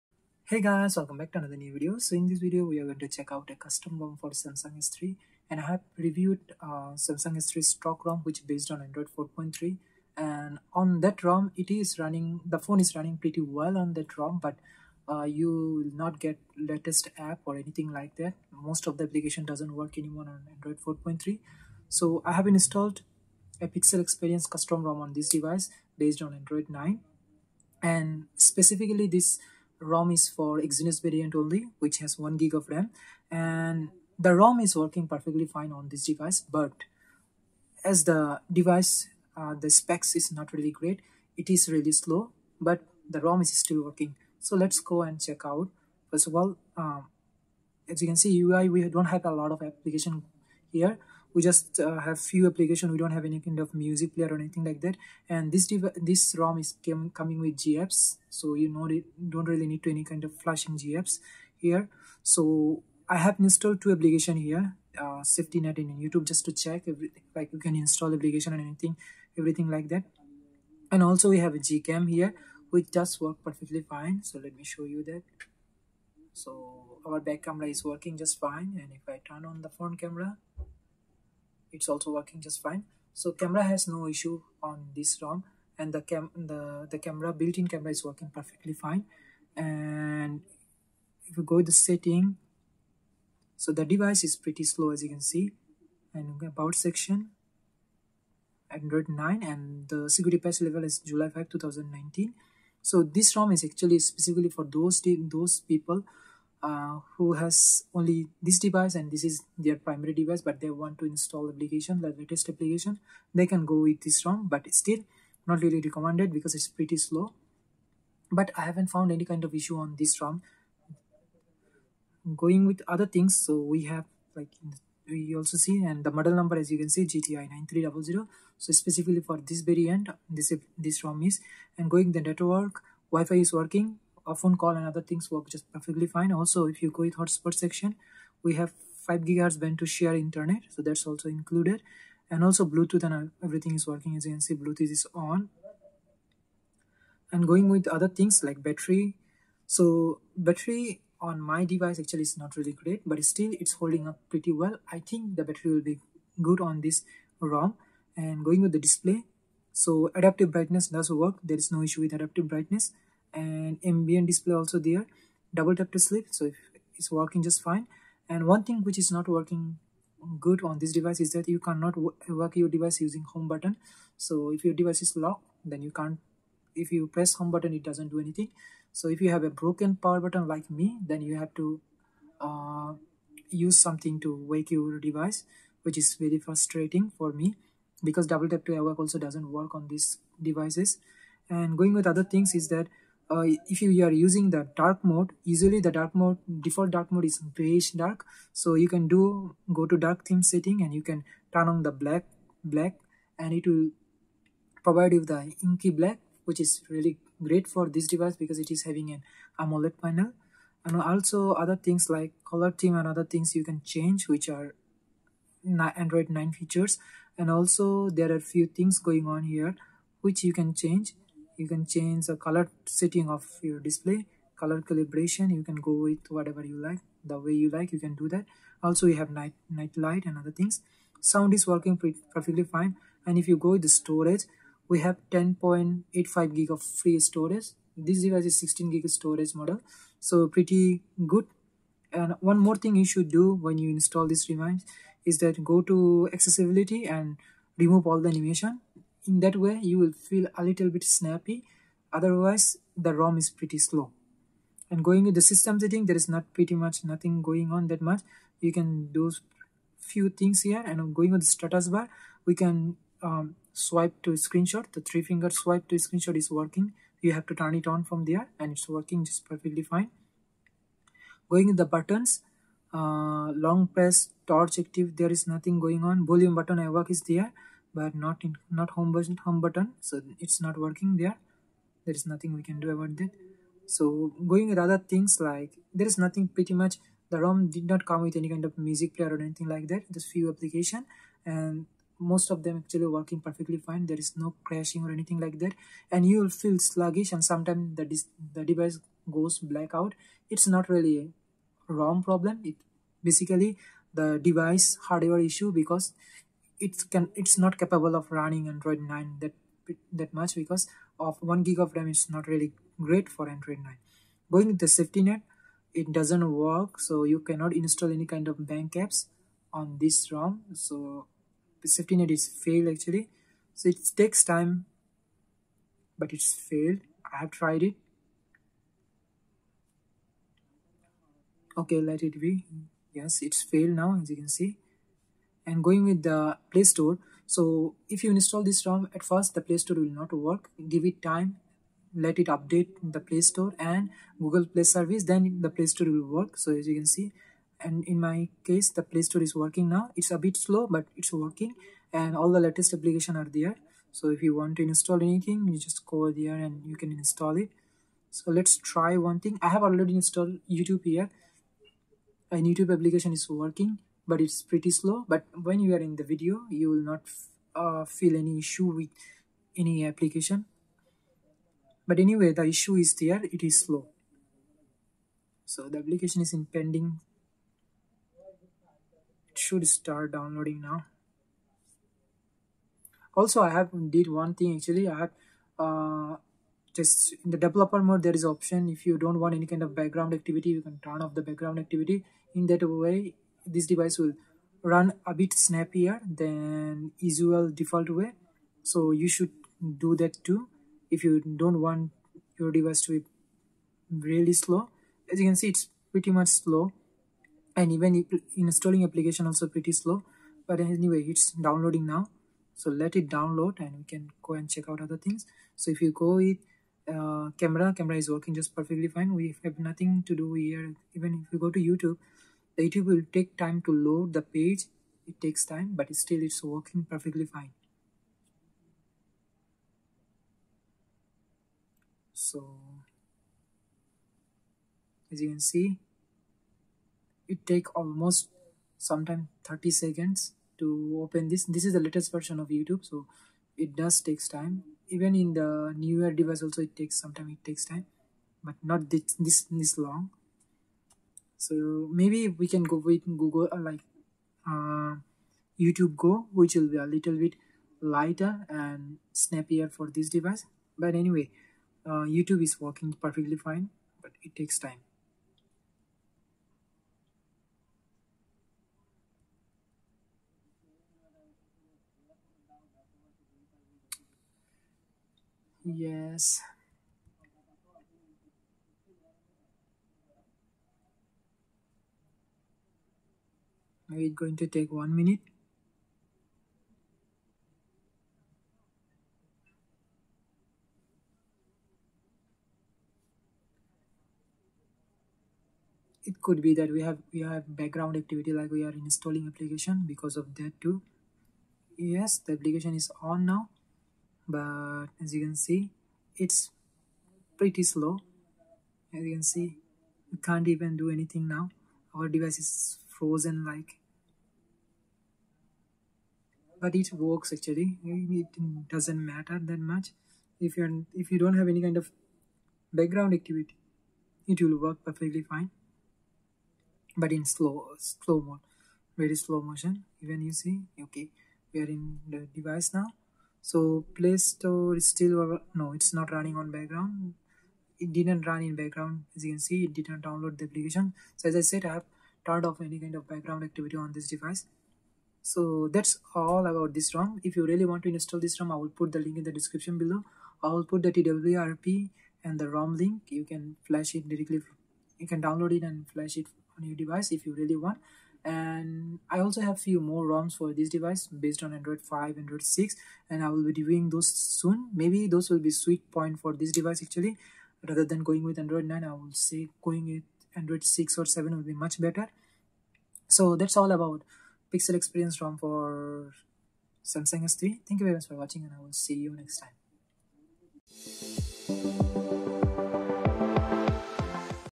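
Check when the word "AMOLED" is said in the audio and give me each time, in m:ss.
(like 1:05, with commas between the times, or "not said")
3:29.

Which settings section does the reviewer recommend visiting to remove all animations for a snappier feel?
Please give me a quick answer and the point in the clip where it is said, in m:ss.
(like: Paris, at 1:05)
accessibility, at 4:06.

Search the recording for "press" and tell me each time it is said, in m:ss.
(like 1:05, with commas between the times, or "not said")
2:57, 4:33.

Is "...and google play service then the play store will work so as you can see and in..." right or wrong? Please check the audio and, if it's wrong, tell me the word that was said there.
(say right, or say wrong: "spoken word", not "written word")
right.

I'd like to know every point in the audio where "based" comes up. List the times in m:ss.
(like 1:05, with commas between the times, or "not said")
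0:08, 0:25, 9:21.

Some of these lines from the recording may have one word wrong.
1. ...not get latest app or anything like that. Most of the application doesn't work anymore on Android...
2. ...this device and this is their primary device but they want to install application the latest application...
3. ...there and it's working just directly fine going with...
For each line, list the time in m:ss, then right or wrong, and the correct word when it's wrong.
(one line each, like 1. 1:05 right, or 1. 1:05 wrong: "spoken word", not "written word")
1. 0:15 right
2. 1:48 right
3. 4:28 wrong: "perfectly", not "directly".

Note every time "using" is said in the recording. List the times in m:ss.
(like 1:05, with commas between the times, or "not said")
2:53, 3:14.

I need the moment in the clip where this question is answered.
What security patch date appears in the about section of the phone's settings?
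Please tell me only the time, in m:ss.
1:40.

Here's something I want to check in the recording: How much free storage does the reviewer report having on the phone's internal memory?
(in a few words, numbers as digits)
10.85 gig.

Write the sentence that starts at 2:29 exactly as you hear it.
So battery on my device actually is not really great, but still it's holding up pretty well.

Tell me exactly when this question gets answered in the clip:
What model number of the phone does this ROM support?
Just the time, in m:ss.
2:07.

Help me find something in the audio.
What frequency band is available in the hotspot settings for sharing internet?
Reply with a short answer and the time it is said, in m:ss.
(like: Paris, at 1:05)
5 gigahertz, at 2:19.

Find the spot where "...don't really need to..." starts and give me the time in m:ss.
0:59.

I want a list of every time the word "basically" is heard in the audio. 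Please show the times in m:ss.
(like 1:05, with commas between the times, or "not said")
5:03.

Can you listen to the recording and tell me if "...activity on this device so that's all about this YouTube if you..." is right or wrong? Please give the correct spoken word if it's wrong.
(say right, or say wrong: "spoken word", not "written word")
wrong: "ROM", not "YouTube".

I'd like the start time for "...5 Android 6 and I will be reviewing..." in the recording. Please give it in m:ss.
9:22.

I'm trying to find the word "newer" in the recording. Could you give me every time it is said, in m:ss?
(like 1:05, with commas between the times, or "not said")
7:25.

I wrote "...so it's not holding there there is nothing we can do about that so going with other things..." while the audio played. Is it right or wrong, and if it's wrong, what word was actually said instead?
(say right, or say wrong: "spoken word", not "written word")
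wrong: "working", not "holding".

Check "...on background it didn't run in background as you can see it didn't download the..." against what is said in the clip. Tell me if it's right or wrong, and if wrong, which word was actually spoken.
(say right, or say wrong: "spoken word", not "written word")
right.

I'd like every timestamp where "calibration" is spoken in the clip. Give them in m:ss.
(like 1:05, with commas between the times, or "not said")
3:44.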